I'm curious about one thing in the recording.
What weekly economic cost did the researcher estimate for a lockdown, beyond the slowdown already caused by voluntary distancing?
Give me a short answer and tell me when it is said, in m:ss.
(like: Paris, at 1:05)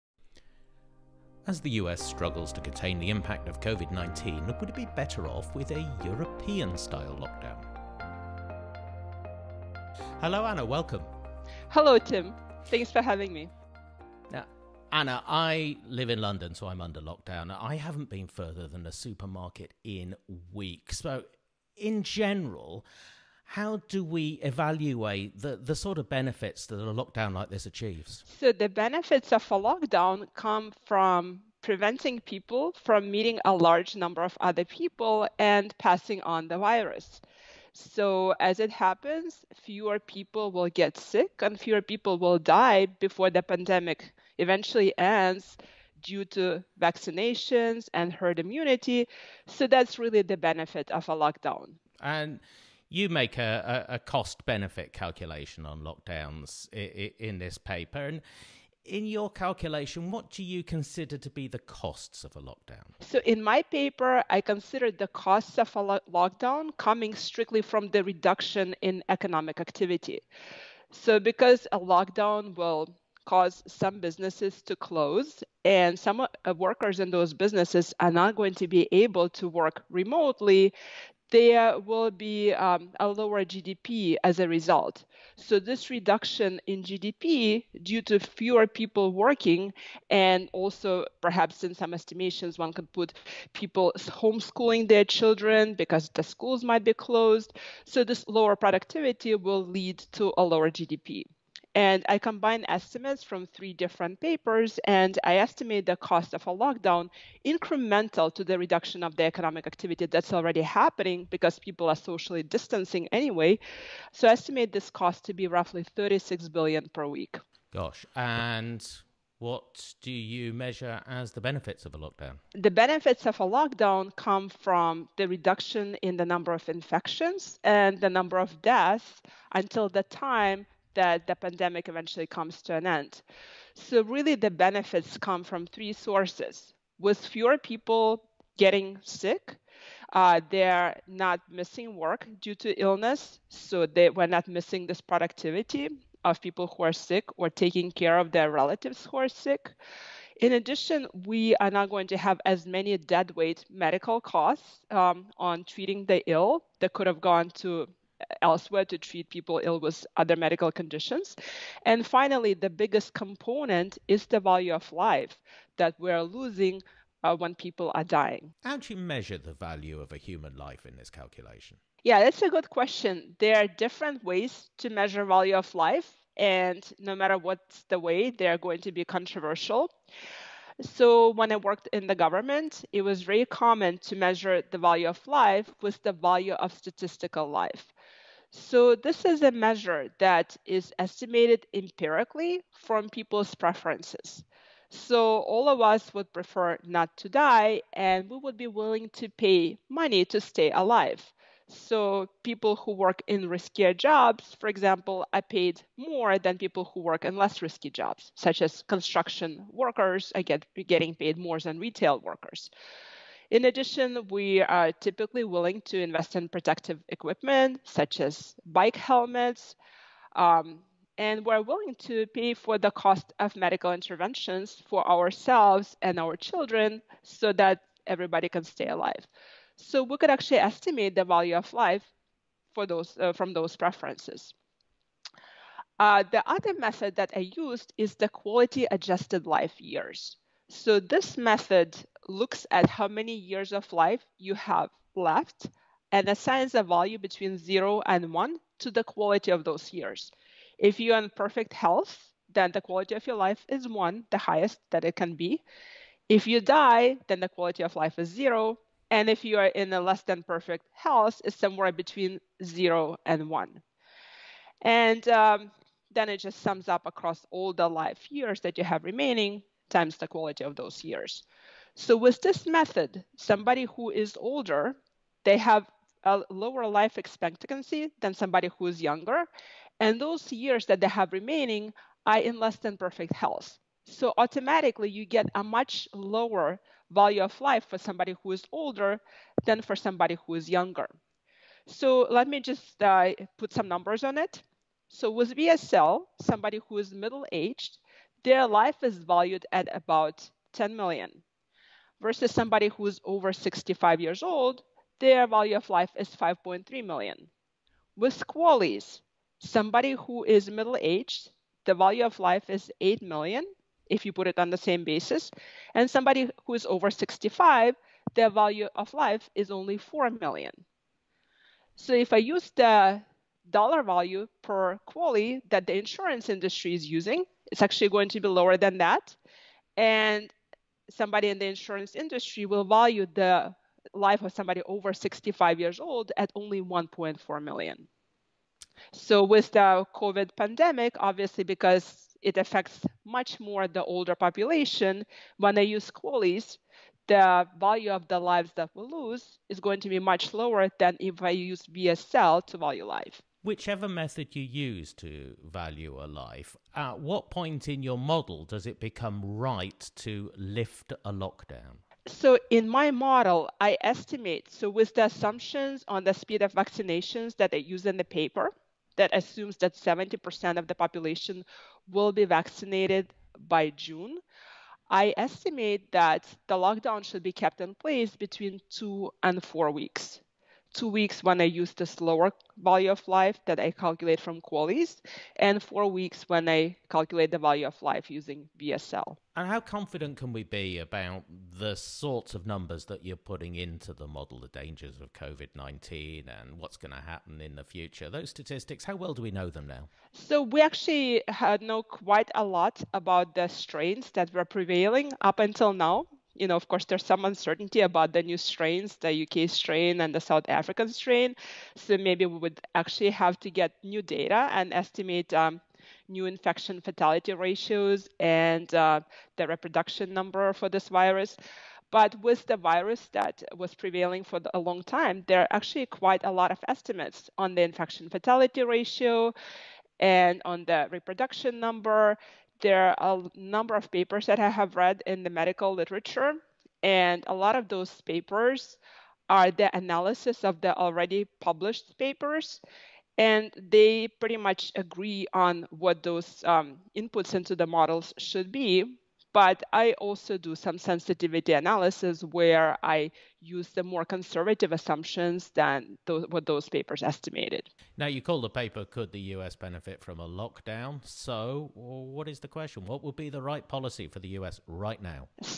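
36 billion per week, at 1:55.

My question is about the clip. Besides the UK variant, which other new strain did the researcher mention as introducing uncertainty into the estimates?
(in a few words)
South African strain.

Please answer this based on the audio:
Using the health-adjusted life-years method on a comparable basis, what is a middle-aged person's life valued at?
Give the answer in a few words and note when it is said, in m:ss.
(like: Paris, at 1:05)
8 million, at 5:12.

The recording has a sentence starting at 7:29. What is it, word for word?
But I also do some sensitivity analysis where I use the more conservative assumptions than those, what those papers estimated.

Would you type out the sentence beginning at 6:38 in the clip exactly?
Those statistics, how well do we know them now?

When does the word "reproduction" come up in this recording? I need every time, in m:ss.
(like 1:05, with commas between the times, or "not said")
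6:59, 7:11.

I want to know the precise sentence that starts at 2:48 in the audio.
How do you measure the value of a human life in this calculation?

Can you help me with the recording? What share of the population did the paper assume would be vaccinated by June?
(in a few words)
70%.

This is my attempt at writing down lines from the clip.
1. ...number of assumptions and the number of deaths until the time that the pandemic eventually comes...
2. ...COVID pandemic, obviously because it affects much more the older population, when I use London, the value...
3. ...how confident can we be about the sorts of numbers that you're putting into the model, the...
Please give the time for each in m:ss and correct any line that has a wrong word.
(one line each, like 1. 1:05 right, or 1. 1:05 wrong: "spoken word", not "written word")
1. 2:06 wrong: "infections", not "assumptions"
2. 5:40 wrong: "QALYs", not "London"
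3. 6:29 right.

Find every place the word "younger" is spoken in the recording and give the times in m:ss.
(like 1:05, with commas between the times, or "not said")
4:38, 4:50.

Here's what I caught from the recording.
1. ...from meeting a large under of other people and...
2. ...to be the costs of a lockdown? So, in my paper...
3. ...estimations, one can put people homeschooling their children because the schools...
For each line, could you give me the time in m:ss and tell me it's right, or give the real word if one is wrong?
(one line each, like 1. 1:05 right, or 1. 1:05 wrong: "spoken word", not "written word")
1. 0:32 wrong: "number", not "under"
2. 1:01 right
3. 1:31 right.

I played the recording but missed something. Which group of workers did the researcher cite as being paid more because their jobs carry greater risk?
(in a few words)
construction workers.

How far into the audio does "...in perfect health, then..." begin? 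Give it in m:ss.
4:11.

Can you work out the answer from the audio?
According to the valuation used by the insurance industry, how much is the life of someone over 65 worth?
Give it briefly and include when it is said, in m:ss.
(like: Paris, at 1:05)
1.4 million, at 5:36.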